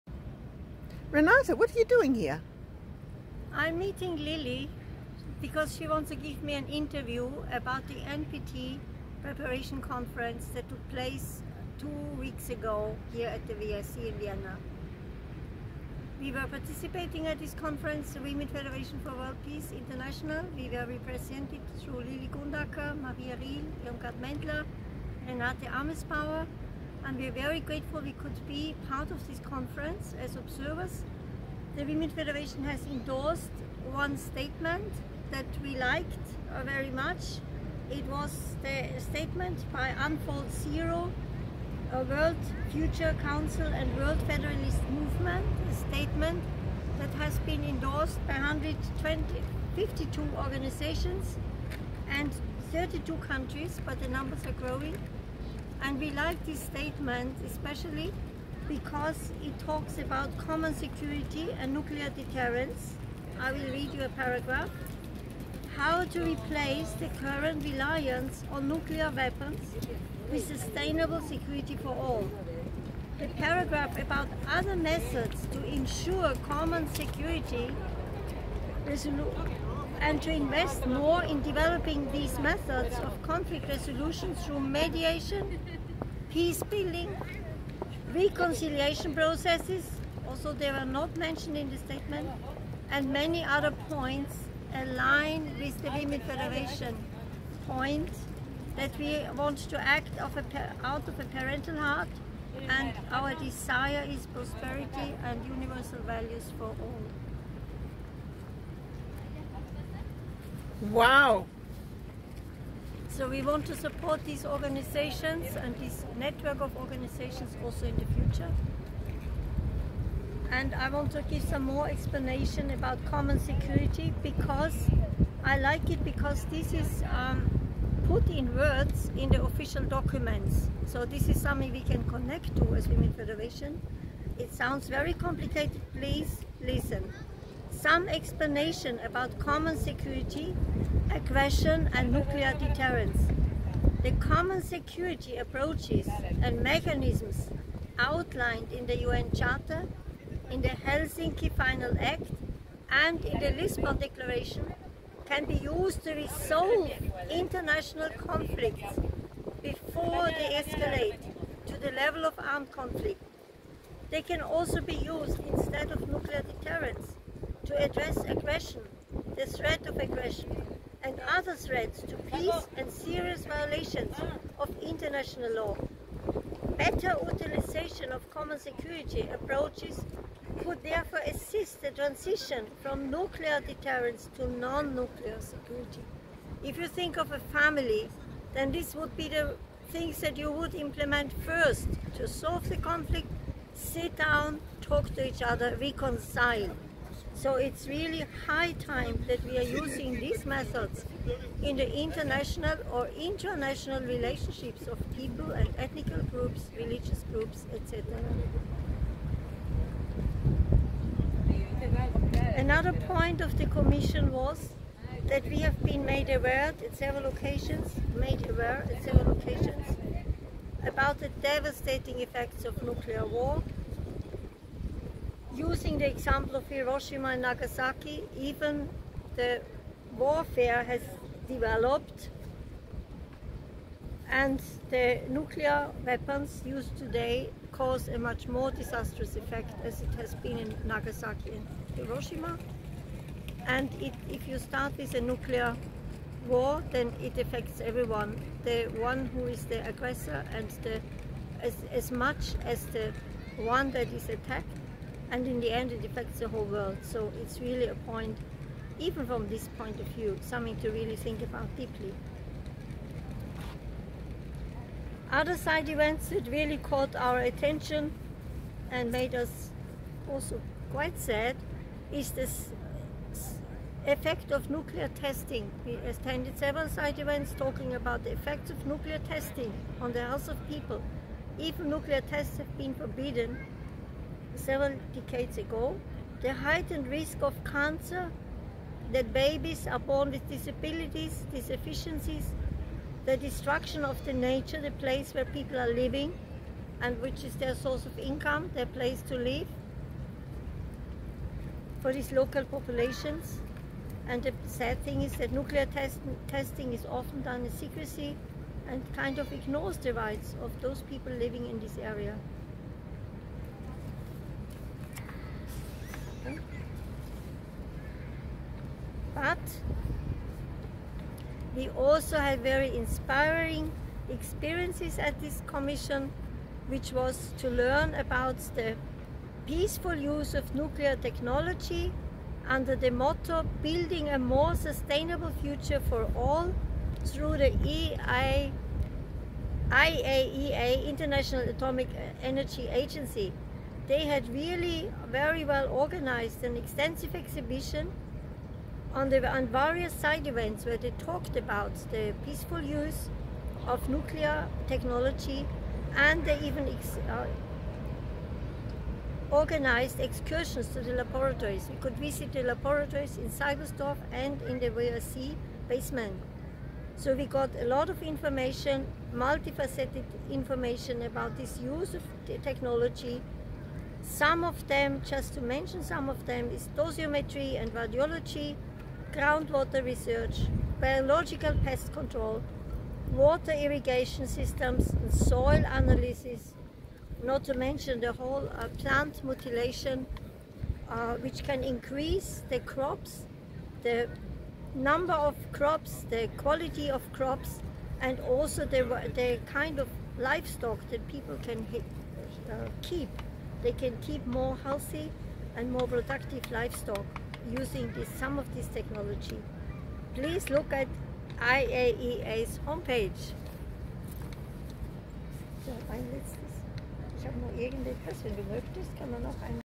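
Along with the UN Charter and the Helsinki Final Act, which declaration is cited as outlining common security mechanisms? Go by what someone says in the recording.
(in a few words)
Lisbon Declaration.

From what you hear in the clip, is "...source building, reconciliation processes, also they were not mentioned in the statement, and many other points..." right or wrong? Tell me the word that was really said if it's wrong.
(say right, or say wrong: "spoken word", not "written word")
wrong: "peace", not "source".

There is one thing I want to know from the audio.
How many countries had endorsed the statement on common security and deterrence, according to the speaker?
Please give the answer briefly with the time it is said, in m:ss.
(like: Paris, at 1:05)
32, at 0:52.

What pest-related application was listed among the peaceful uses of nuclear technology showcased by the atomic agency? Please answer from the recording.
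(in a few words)
Biological pest control.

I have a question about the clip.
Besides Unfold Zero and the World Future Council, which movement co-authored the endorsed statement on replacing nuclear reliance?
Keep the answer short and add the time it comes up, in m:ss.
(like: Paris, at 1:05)
World Federalist Movement, at 0:43.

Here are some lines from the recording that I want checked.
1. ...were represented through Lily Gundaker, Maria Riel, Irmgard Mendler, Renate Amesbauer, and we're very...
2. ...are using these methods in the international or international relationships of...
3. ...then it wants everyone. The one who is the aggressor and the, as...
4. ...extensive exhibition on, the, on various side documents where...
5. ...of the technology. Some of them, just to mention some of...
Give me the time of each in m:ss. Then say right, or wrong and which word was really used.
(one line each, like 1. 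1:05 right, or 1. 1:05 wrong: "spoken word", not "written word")
1. 0:20 right
2. 3:19 right
3. 4:06 wrong: "affects", not "wants"
4. 5:46 wrong: "events", not "documents"
5. 6:12 right.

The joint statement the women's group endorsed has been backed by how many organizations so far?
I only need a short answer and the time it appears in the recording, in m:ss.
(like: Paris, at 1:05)
152, at 0:48.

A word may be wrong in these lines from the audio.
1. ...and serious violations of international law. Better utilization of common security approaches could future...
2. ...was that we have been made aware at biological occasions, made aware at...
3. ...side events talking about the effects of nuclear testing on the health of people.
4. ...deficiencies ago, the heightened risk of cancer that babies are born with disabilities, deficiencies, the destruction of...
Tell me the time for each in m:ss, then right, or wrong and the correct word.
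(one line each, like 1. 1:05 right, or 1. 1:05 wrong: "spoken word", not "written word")
1. 2:52 wrong: "therefore", not "future"
2. 3:34 wrong: "several", not "biological"
3. 4:36 right
4. 4:45 wrong: "decades", not "deficiencies".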